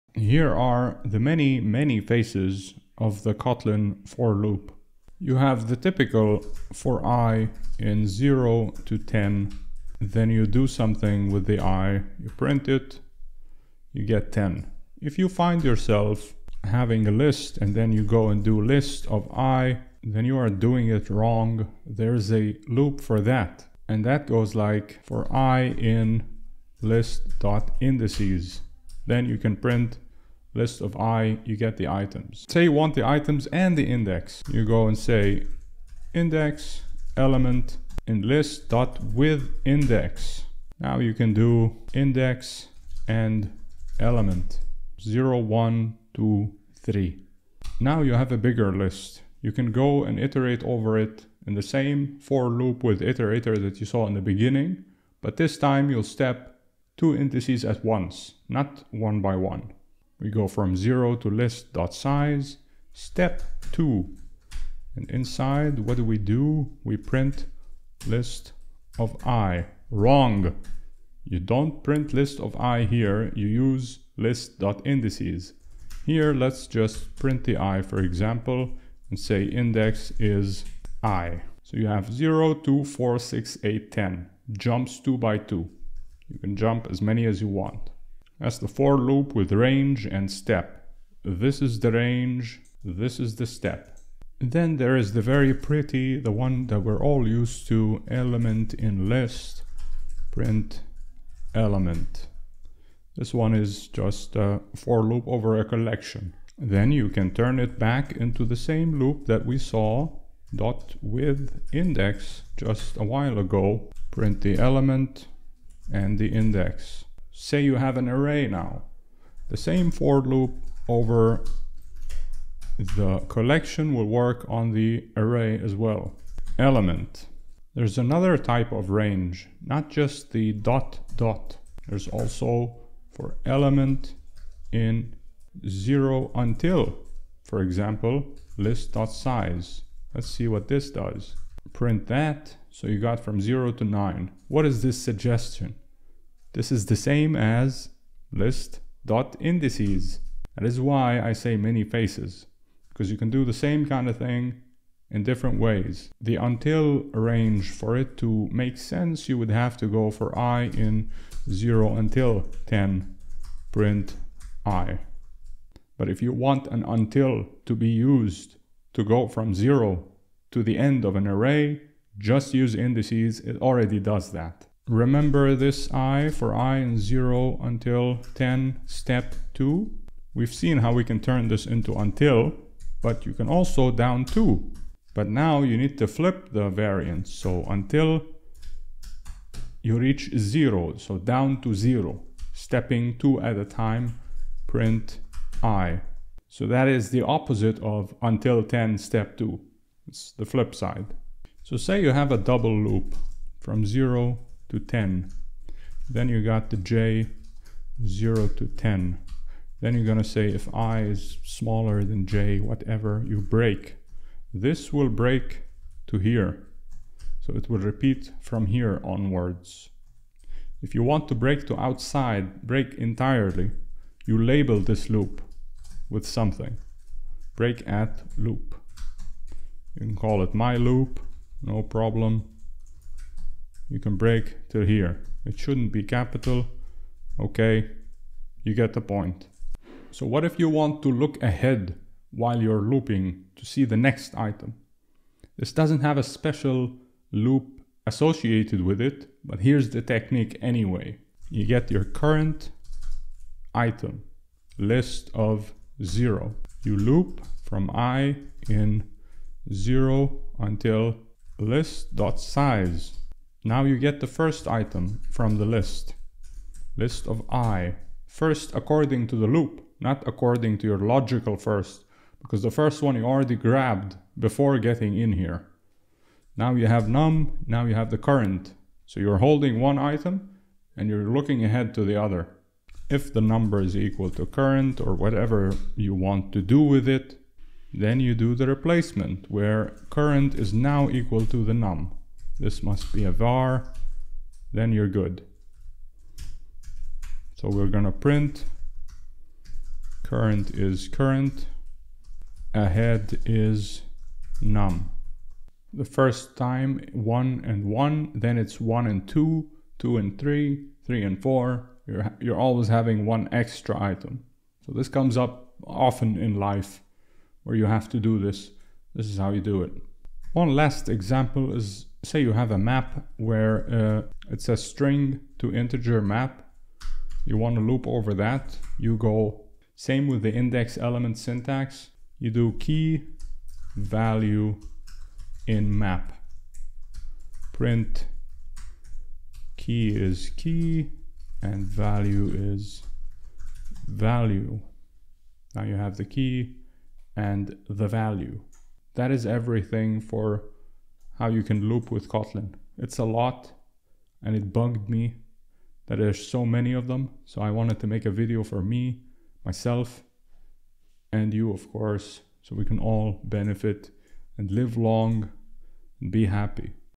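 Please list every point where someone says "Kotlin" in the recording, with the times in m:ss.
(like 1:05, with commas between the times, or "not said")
0:03, 5:52.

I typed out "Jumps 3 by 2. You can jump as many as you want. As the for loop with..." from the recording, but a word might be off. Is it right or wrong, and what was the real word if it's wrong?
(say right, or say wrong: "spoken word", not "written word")
wrong: "2", not "3".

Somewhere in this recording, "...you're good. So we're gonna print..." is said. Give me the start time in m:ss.
4:54.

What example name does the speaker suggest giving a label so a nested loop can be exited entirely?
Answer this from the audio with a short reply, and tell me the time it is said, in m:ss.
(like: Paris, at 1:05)
my loop, at 3:50.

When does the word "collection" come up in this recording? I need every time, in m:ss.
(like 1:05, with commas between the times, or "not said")
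1:45, 2:03.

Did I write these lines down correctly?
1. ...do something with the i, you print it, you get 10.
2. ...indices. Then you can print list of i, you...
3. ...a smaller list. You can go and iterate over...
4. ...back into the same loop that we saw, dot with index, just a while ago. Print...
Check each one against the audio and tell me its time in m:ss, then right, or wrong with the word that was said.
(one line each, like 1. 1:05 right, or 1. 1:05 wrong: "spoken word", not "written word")
1. 0:10 right
2. 0:27 right
3. 0:48 wrong: "bigger", not "smaller"
4. 1:47 right.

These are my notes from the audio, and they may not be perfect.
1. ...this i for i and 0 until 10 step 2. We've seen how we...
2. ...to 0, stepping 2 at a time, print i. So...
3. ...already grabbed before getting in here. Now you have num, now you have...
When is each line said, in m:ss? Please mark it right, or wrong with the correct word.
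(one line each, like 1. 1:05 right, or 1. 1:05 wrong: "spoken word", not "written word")
1. 2:55 right
2. 3:11 right
3. 4:33 right.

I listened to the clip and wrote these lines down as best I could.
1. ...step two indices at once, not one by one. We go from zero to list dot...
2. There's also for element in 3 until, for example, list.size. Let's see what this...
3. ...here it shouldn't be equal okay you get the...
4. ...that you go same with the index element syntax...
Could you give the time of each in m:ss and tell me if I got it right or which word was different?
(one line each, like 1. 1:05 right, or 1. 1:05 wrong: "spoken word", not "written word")
1. 0:56 right
2. 2:11 wrong: "0", not "3"
3. 3:54 wrong: "capital", not "equal"
4. 5:28 right.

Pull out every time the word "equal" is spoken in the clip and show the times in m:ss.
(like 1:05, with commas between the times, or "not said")
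4:43, 4:51.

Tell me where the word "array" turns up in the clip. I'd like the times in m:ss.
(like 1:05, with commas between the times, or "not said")
1:58, 2:05, 2:51.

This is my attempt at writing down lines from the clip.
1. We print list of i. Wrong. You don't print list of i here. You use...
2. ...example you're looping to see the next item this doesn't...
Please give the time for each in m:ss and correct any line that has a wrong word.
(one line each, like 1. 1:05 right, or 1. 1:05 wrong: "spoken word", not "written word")
1. 1:06 right
2. 4:02 wrong: "while", not "example".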